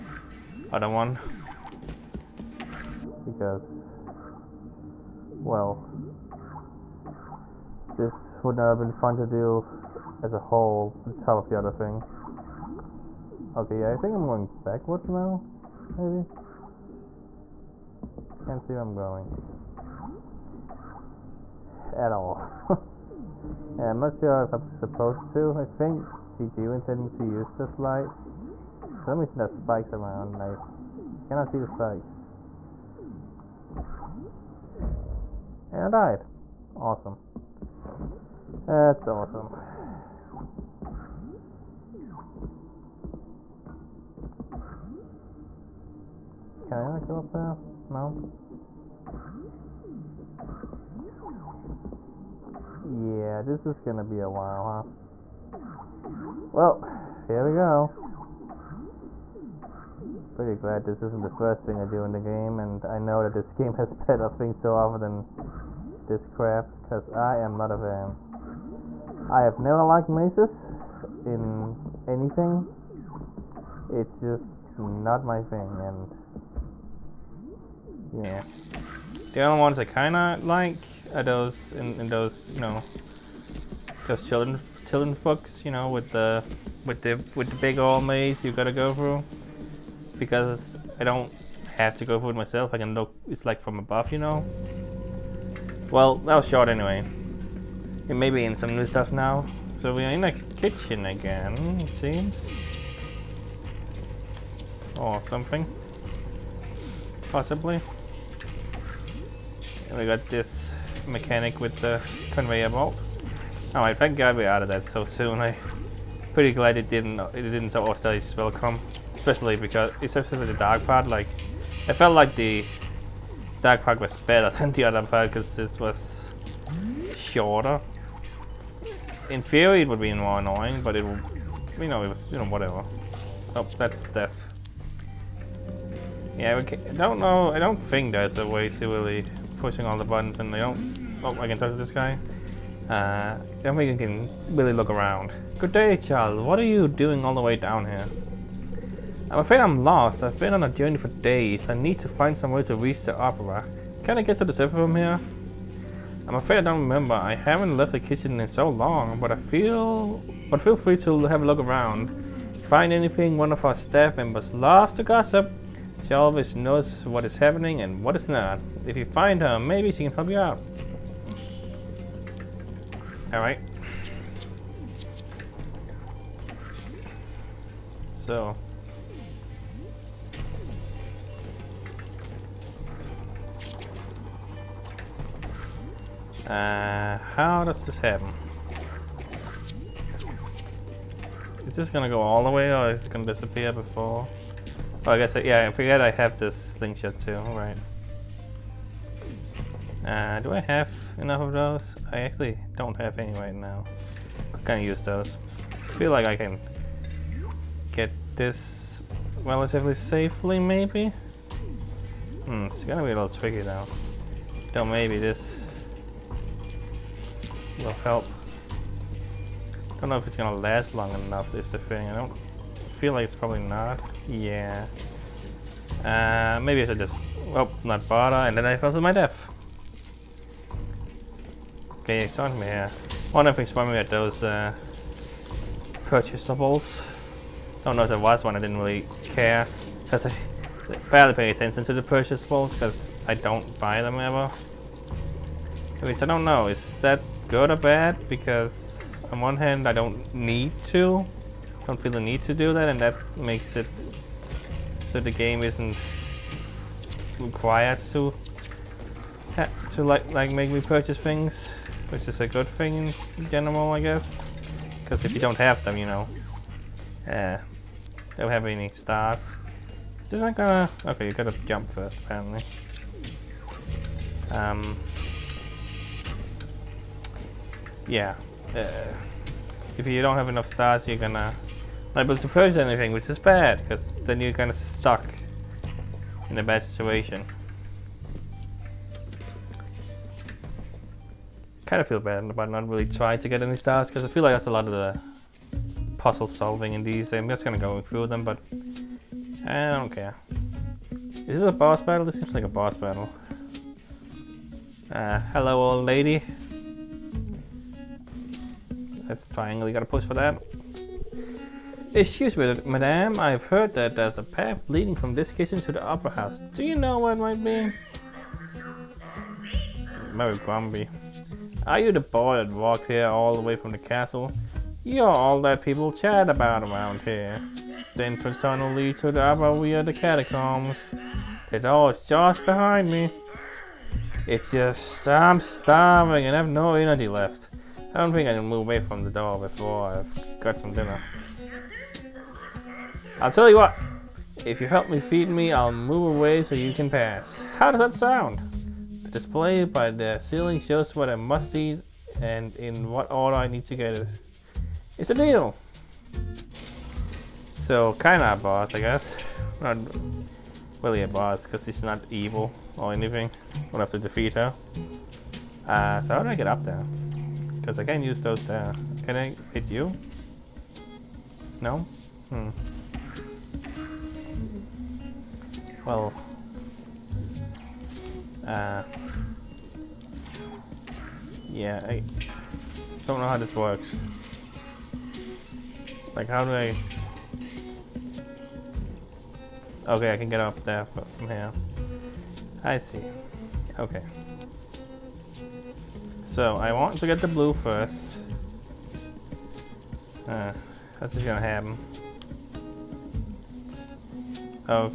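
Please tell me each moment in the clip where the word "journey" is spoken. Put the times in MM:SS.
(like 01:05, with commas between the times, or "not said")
02:30.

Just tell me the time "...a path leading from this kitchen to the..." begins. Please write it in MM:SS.
05:14.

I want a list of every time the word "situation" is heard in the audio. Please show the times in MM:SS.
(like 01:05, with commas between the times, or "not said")
04:46.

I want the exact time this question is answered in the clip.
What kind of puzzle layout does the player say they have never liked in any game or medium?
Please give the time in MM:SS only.
01:10.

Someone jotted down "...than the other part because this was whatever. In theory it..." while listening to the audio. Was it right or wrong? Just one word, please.
wrong.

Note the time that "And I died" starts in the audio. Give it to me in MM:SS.
00:35.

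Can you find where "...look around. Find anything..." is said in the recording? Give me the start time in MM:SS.
02:41.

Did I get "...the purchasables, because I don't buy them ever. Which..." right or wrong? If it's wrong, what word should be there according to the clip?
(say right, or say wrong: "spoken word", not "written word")
right.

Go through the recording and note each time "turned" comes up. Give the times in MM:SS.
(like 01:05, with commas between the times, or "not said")
not said.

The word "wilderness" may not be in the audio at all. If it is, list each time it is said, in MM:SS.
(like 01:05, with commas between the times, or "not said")
not said.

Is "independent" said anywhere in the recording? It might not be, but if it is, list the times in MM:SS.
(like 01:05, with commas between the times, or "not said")
not said.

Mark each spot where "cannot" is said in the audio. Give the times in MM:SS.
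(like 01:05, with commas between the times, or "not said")
00:31.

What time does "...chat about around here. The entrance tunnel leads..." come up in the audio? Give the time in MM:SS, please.
05:26.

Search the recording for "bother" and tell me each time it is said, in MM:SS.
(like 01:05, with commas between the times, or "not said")
03:48.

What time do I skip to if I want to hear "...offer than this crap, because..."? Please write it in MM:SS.
01:04.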